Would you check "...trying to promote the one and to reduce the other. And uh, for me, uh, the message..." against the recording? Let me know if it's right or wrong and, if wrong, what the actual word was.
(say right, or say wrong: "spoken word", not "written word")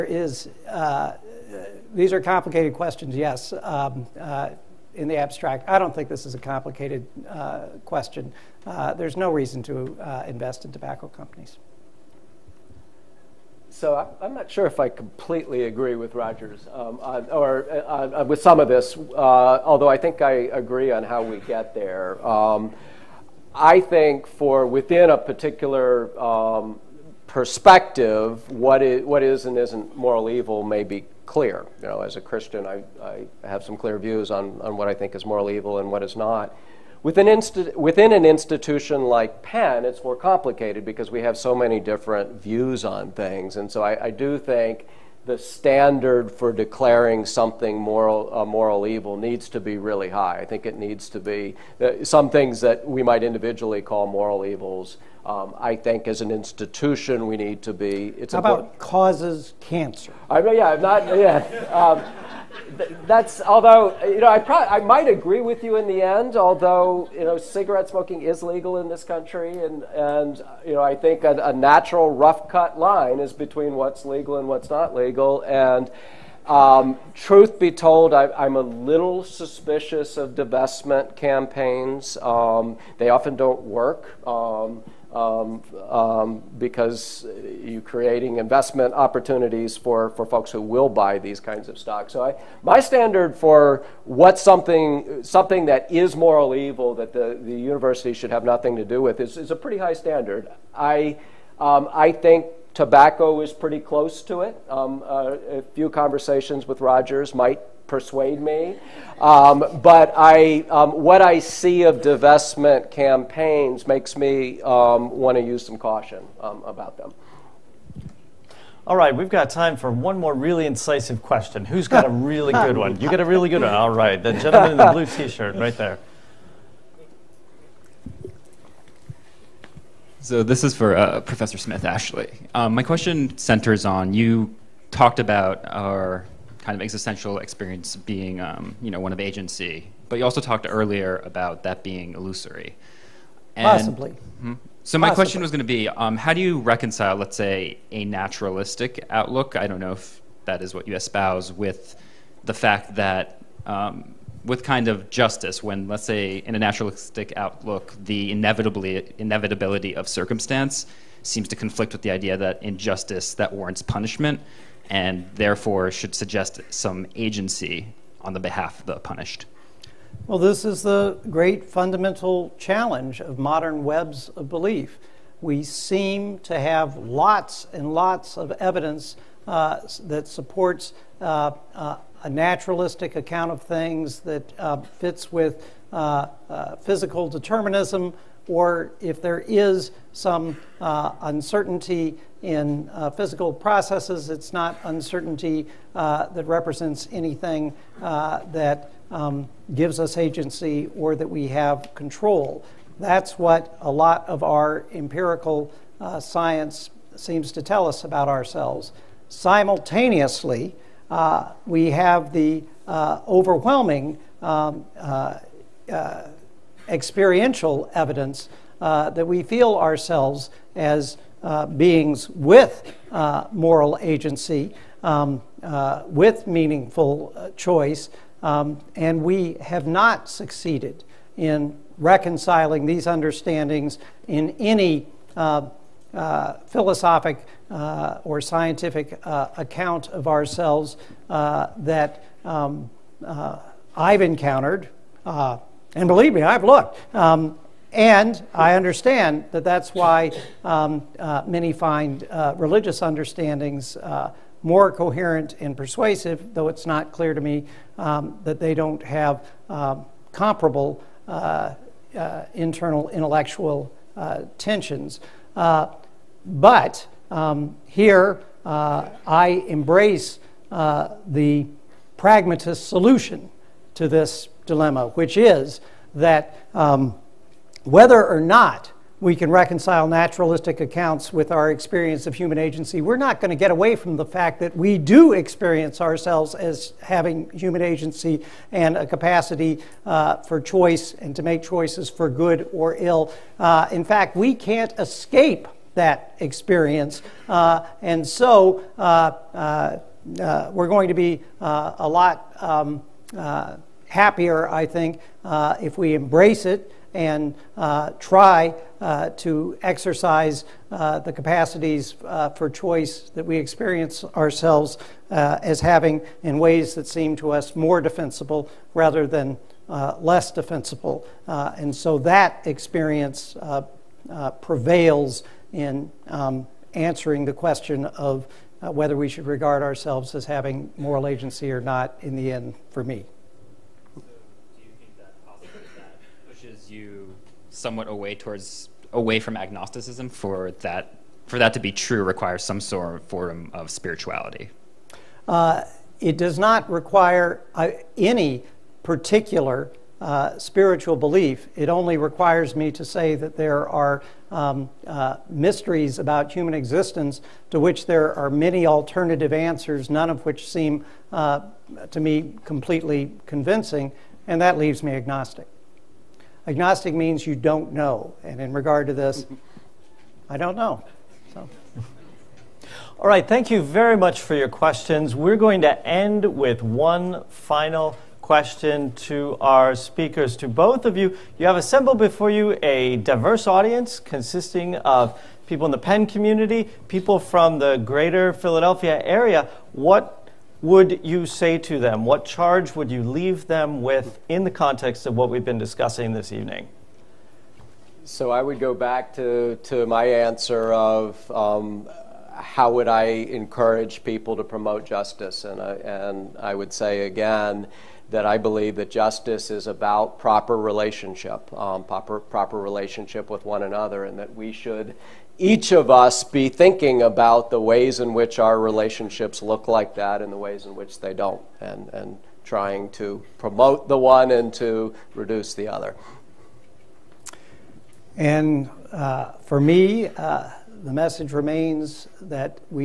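right.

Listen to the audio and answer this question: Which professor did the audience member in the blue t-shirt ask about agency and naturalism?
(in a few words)
Professor Smith.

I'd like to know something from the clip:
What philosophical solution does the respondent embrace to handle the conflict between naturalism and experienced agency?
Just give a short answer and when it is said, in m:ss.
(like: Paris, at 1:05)
The pragmatist solution, at 4:32.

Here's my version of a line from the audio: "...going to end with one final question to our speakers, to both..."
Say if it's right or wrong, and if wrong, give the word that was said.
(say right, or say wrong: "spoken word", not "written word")
right.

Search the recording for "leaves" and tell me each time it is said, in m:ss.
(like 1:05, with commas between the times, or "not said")
6:04, 6:33.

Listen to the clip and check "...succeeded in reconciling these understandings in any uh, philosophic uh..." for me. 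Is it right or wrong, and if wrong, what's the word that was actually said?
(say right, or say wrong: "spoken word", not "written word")
right.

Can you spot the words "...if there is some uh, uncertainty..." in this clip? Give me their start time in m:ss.
3:08.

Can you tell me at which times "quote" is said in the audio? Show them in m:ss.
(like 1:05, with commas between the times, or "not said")
not said.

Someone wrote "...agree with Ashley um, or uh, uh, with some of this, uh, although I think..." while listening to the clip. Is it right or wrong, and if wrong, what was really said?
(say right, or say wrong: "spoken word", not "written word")
wrong: "Rogers", not "Ashley".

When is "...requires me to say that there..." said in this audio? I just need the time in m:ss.
5:52.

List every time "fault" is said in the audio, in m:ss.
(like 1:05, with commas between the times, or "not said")
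not said.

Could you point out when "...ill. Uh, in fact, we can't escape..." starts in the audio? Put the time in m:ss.
4:52.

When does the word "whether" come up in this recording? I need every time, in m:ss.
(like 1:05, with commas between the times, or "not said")
4:37, 5:28.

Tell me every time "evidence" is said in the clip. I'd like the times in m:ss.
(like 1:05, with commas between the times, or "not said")
2:58, 3:37.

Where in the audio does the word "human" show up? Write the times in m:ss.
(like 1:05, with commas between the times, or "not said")
4:42, 4:47, 5:56.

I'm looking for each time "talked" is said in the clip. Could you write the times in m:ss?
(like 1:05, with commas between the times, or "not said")
2:14, 2:20.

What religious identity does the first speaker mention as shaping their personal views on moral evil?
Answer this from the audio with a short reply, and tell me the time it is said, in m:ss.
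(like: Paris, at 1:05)
Christian, at 0:32.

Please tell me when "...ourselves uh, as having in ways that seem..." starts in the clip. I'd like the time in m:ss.
5:14.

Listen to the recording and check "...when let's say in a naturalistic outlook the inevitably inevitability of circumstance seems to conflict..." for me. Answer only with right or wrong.
right.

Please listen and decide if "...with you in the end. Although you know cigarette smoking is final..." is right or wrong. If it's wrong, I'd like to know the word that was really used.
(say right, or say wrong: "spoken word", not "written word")
wrong: "legal", not "final".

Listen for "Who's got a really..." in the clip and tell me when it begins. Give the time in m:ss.
2:01.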